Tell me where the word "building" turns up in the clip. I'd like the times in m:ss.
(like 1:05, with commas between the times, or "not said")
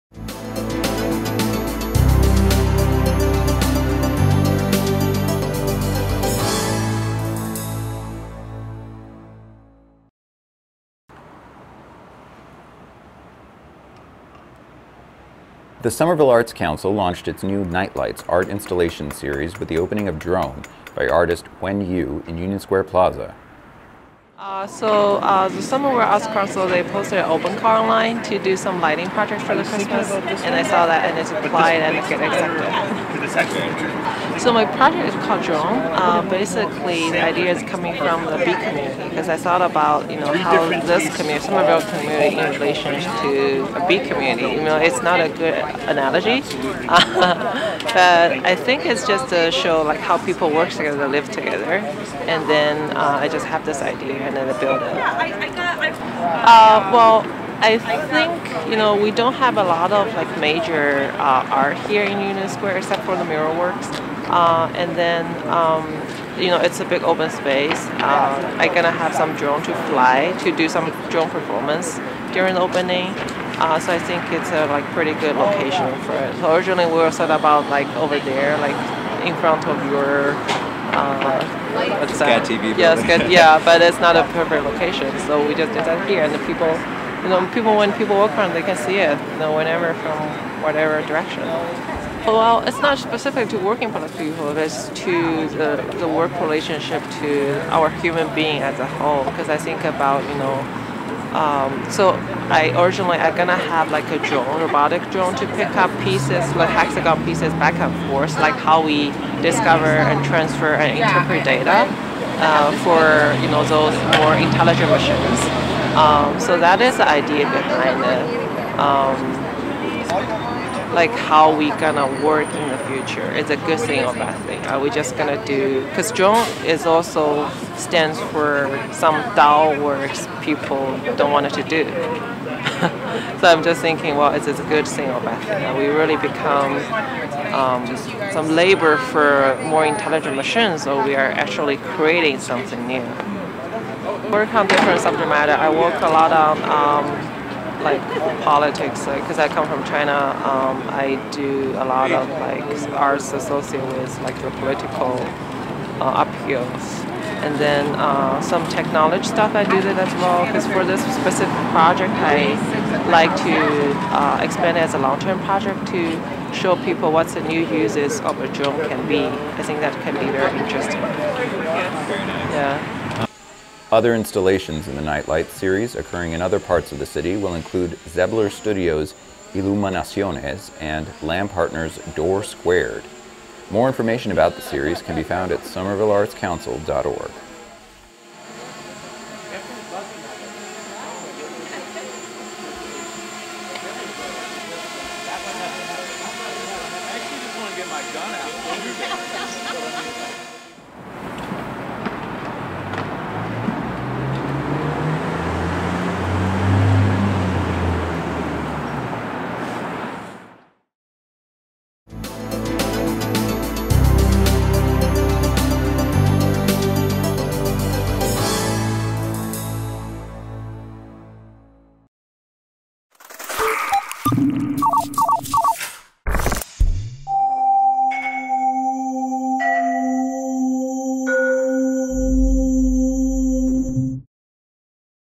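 0:54.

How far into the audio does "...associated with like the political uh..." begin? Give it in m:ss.
2:33.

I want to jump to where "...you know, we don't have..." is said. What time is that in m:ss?
0:58.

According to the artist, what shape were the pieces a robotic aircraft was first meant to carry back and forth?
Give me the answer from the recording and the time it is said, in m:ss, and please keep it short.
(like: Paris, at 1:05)
Hexagon, at 1:46.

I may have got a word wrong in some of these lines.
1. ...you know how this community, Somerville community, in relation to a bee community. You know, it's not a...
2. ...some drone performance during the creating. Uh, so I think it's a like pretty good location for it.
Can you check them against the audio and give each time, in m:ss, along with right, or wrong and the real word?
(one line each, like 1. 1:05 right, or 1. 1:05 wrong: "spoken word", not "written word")
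1. 0:40 right
2. 1:10 wrong: "opening", not "creating".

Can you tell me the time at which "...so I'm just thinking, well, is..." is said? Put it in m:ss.
2:13.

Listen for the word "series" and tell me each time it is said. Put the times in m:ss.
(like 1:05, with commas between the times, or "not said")
0:19, 2:55, 3:04.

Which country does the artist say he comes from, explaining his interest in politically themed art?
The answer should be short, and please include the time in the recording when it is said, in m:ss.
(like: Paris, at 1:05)
China, at 2:29.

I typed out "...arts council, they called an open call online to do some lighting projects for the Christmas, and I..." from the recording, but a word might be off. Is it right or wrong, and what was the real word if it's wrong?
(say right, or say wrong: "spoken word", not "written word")
wrong: "posted", not "called".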